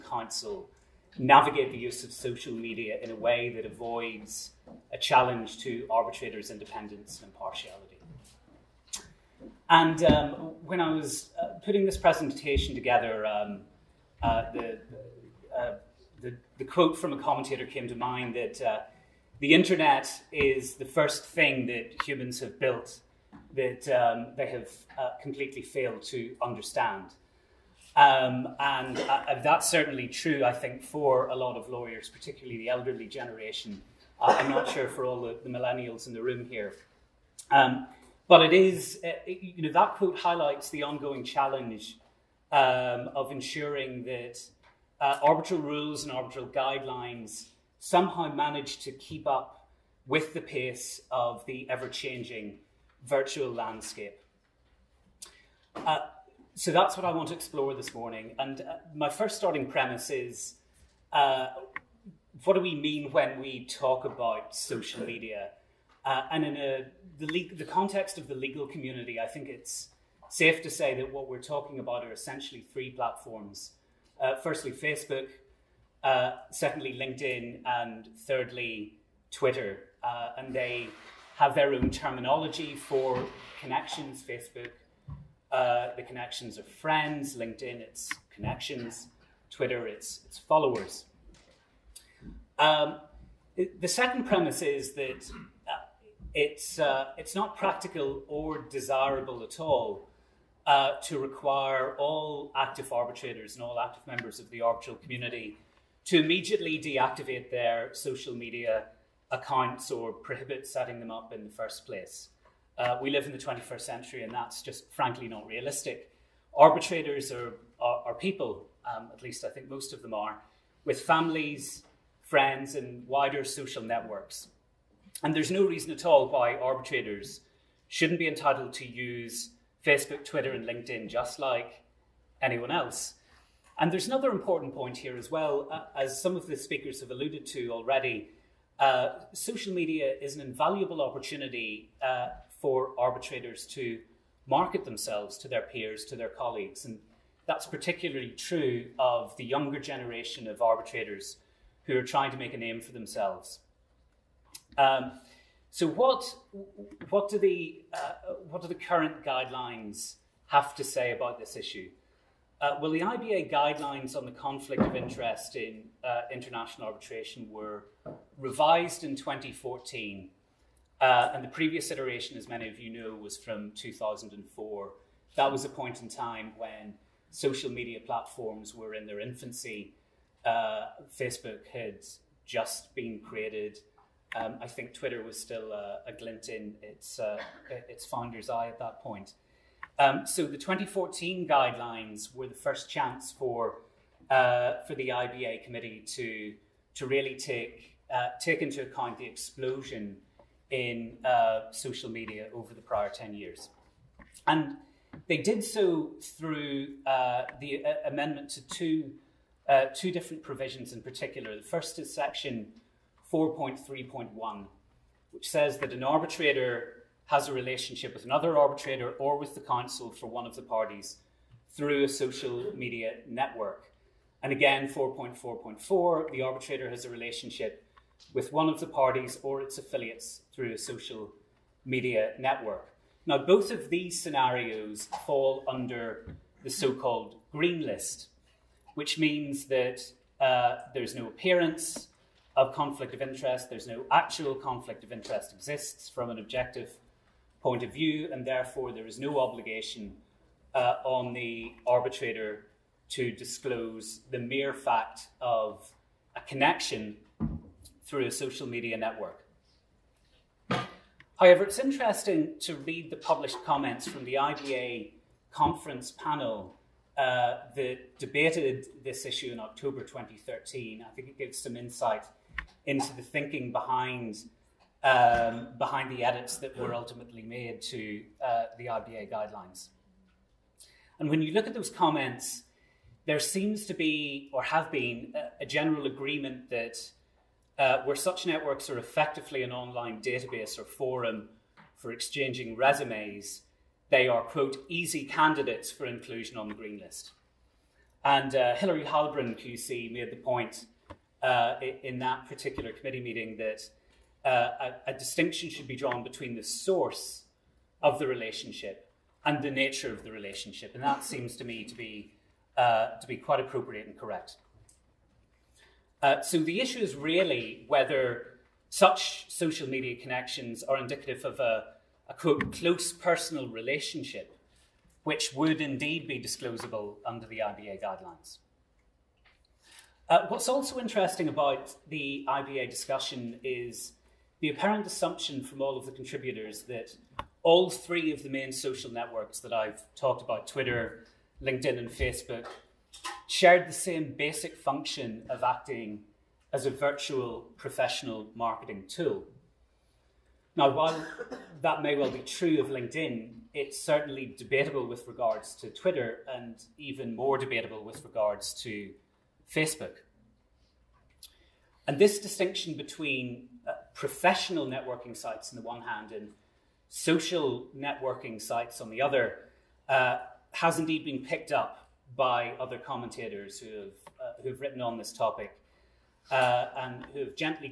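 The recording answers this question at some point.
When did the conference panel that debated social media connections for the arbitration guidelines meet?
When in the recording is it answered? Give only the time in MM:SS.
04:29.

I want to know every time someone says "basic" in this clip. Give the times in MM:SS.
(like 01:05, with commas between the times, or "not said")
05:44.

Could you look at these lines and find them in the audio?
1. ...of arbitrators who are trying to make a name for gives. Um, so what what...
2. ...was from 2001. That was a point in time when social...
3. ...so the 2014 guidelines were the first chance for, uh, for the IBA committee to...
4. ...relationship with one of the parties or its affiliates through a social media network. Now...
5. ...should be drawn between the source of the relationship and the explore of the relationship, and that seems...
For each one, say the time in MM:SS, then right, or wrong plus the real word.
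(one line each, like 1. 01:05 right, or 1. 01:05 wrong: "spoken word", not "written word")
1. 02:30 wrong: "themselves", not "gives"
2. 02:53 wrong: "2004", not "2001"
3. 03:10 right
4. 03:47 right
5. 05:05 wrong: "nature", not "explore".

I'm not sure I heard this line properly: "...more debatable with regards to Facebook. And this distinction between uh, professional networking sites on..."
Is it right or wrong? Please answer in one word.
right.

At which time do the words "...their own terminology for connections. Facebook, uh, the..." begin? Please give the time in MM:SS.
01:21.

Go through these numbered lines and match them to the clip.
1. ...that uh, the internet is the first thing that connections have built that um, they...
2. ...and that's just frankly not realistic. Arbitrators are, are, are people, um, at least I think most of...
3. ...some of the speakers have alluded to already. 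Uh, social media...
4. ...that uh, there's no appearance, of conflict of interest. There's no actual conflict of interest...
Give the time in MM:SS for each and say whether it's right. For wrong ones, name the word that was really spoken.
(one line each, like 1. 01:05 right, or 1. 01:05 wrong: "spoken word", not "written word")
1. 00:18 wrong: "humans", not "connections"
2. 01:54 right
3. 02:16 right
4. 03:59 right.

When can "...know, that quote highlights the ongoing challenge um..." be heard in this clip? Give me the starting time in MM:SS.
00:39.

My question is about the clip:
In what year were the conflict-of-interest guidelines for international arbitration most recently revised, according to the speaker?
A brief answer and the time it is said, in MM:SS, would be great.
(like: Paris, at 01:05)
2014, at 02:47.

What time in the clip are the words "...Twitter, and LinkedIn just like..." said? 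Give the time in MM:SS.
02:10.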